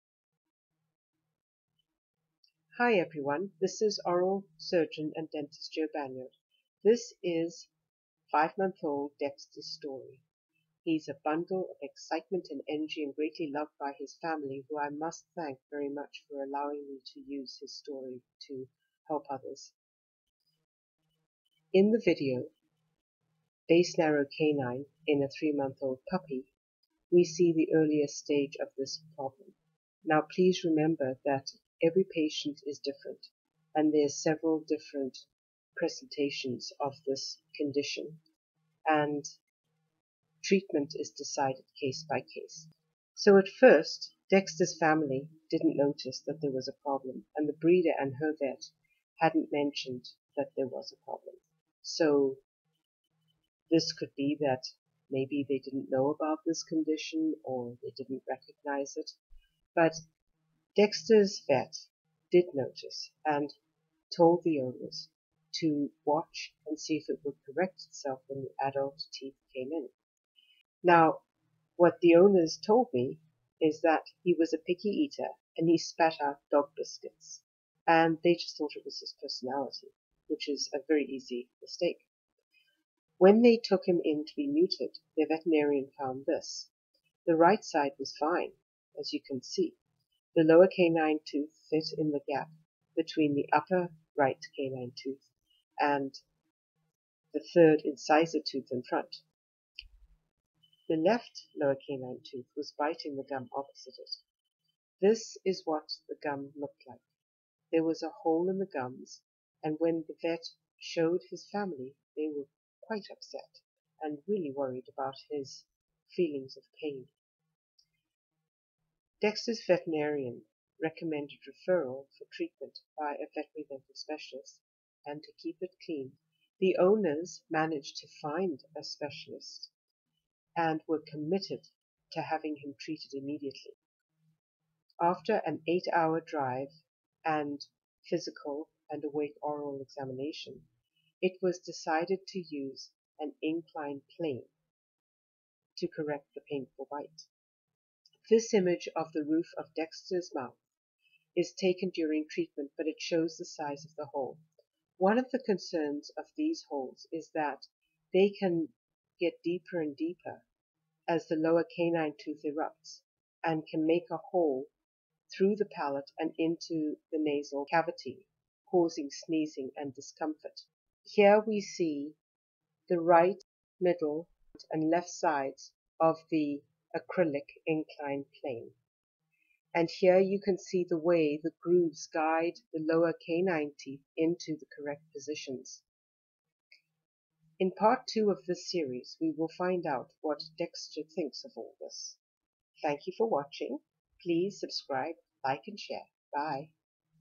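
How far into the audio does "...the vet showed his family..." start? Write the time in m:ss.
1:50.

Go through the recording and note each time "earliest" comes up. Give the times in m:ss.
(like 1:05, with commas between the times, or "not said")
0:27.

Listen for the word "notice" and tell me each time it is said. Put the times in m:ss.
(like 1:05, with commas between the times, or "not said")
0:45, 1:02.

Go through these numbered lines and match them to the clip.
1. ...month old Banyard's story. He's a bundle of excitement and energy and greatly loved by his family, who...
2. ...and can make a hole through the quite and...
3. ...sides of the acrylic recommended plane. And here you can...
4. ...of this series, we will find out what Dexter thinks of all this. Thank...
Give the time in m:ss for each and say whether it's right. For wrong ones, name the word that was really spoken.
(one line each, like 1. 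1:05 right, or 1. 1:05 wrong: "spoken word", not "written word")
1. 0:08 wrong: "Dexter", not "Banyard"
2. 2:43 wrong: "palate", not "quite"
3. 2:55 wrong: "inclined", not "recommended"
4. 3:08 right.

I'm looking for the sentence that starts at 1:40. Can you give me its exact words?
The left lower canine tooth was biting the gum opposite it.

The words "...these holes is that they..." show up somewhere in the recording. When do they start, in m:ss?
2:36.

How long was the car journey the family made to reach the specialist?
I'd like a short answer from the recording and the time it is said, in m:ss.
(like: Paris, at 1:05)
8 hours, at 2:15.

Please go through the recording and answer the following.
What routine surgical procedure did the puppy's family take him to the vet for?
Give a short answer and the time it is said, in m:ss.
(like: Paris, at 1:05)
Neutered, at 1:24.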